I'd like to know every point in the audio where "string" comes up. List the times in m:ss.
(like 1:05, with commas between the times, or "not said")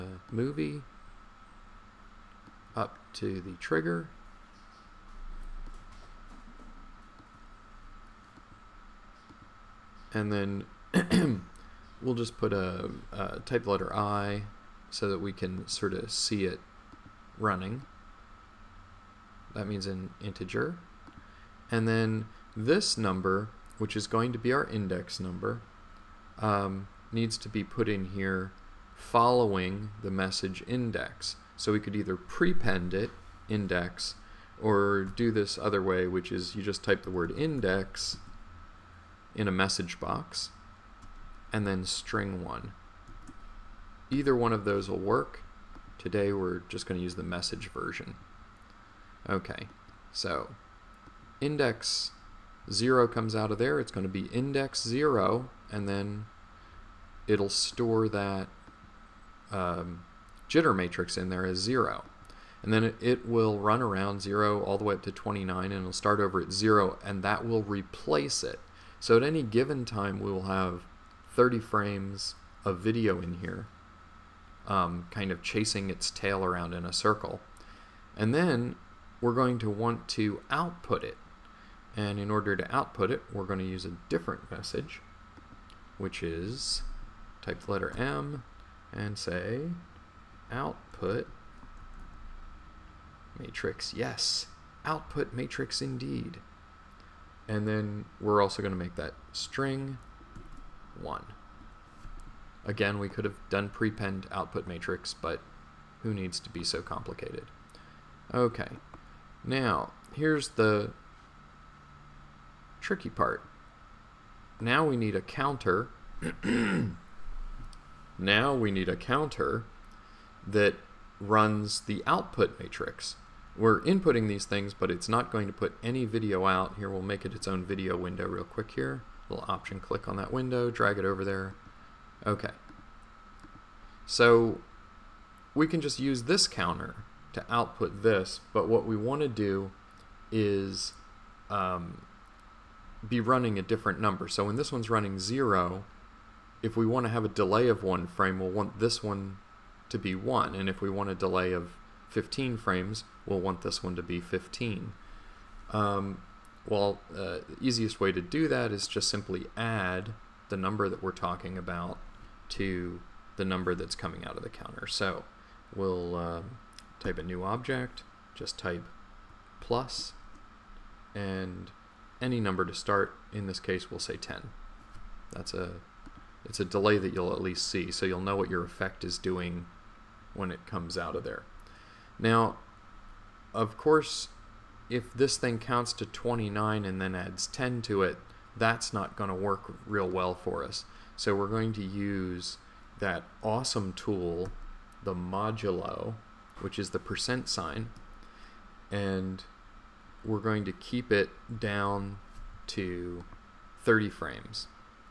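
0:41, 1:39.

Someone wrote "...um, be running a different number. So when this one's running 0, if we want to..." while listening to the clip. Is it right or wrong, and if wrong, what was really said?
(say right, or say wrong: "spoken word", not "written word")
right.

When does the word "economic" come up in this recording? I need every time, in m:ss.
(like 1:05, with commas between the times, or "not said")
not said.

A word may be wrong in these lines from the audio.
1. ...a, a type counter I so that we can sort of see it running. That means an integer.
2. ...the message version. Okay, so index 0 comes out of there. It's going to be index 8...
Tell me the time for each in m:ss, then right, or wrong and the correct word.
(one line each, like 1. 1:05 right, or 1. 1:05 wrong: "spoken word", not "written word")
1. 0:12 wrong: "letter", not "counter"
2. 0:47 wrong: "0", not "8".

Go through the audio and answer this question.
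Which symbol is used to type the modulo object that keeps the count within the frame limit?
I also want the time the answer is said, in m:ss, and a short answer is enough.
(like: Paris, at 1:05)
percent sign, at 3:16.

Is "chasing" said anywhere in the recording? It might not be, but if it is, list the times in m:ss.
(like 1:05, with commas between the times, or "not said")
1:15.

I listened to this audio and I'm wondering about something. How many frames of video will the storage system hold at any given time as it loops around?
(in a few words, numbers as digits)
30.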